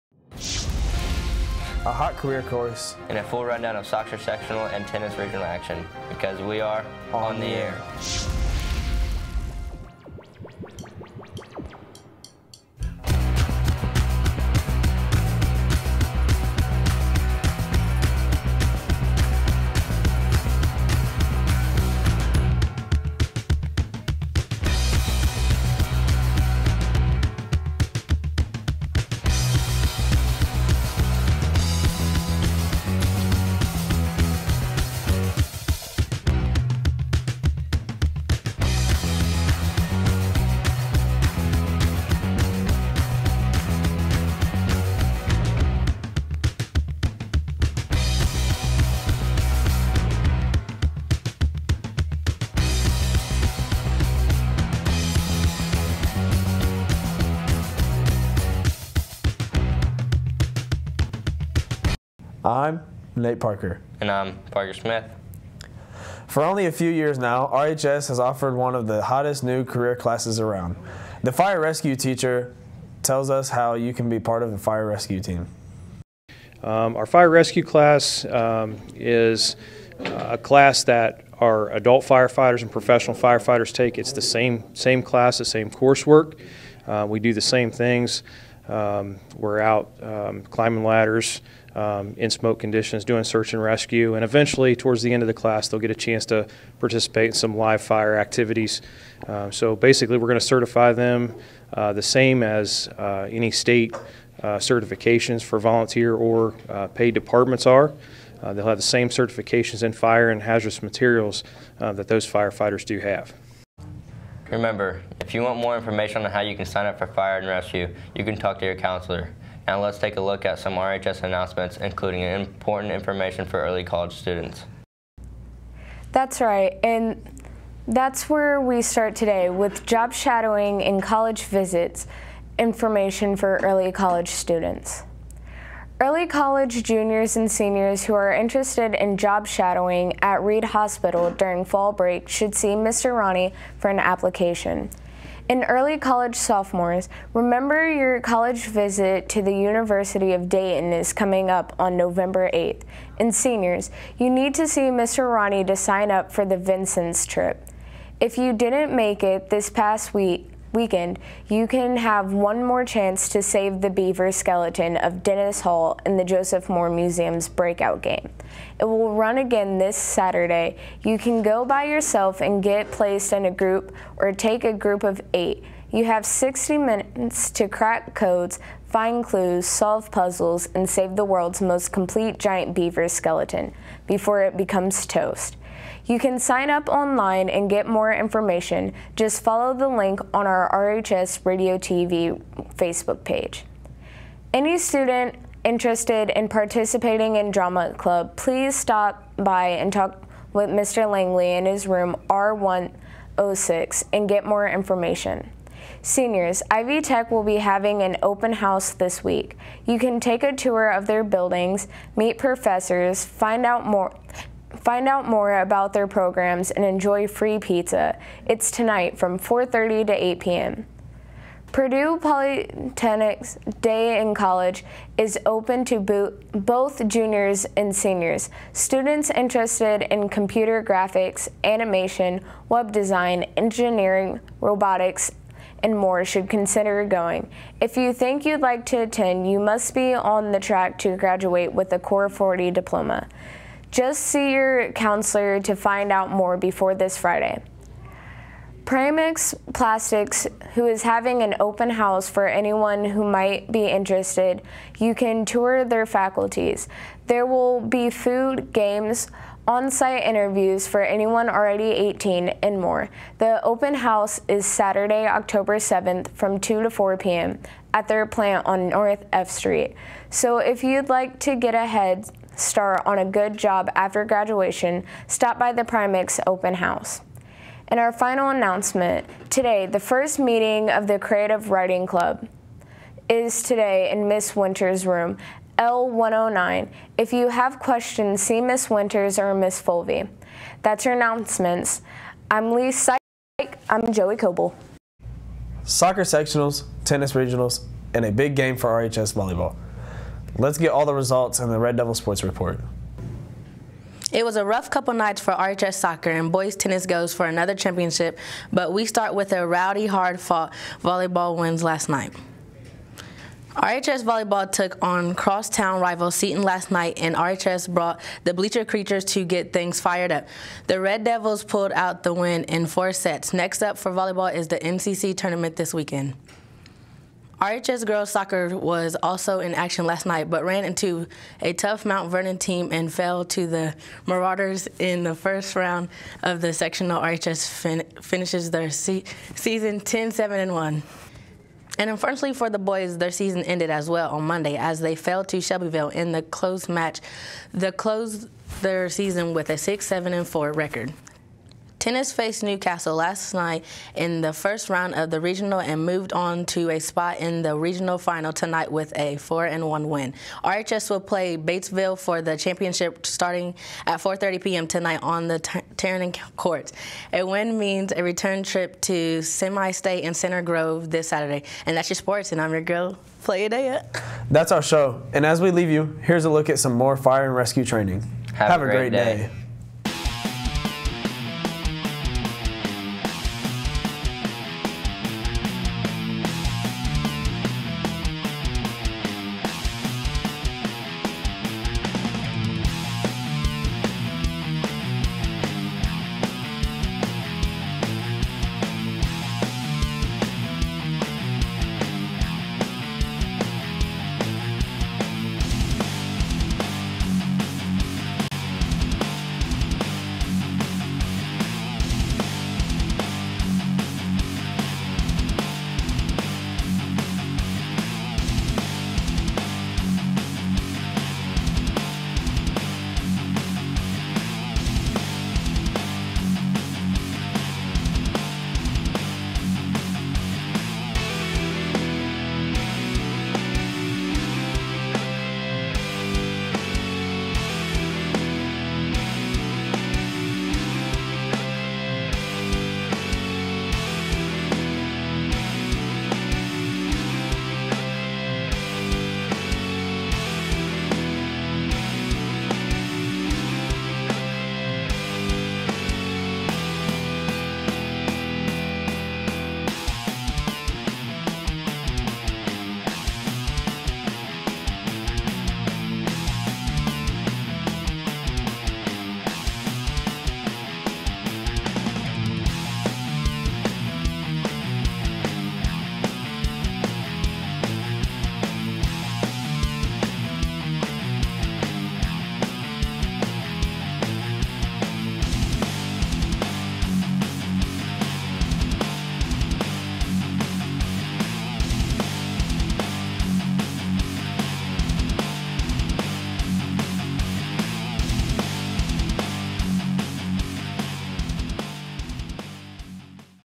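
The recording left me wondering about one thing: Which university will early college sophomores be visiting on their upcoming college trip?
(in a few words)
University of Dayton.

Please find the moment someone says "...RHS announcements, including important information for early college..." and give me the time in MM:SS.
02:00.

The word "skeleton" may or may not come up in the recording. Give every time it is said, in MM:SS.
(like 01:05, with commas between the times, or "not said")
02:44, 03:03.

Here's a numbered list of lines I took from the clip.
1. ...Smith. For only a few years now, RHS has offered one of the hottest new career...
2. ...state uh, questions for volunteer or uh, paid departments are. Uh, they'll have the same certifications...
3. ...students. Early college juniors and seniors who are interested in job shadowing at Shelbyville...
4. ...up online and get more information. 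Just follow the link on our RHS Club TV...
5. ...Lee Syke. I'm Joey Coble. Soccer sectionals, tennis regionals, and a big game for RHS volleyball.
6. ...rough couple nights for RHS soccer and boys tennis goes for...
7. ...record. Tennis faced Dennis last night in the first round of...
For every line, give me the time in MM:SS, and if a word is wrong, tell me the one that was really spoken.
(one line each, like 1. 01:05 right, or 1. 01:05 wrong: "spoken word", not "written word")
1. 01:04 right
2. 01:43 wrong: "certifications", not "questions"
3. 02:14 wrong: "Reid", not "Shelbyville"
4. 03:06 wrong: "Radio", not "Club"
5. 04:52 right
6. 05:04 right
7. 05:50 wrong: "Newcastle", not "Dennis".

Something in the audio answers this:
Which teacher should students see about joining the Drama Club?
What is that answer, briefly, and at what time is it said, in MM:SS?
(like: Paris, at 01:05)
Mr. Langley, at 03:20.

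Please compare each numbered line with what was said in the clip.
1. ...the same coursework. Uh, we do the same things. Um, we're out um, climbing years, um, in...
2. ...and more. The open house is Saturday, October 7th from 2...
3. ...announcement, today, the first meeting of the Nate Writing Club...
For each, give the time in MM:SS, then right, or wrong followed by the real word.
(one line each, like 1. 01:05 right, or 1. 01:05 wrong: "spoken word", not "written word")
1. 01:25 wrong: "ladders", not "years"
2. 04:22 right
3. 04:38 wrong: "Creative", not "Nate".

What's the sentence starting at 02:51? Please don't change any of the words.
You can go by yourself and get placed in a group or take a group of eight.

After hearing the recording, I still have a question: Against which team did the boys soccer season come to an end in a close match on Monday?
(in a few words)
Shelbyville.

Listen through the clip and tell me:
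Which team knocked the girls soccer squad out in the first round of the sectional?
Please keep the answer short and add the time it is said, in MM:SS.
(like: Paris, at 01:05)
Mount Vernon, at 05:32.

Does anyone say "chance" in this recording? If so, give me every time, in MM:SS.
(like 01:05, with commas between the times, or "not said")
01:35, 02:42.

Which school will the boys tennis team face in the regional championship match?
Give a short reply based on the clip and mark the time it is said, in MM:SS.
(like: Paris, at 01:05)
Batesville, at 06:01.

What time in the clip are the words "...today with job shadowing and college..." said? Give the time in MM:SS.
02:09.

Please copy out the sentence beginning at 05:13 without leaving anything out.
RHS volleyball took on crosstown rival Seton last night, and RHS brought the Bleacher Creatures to get things fired up.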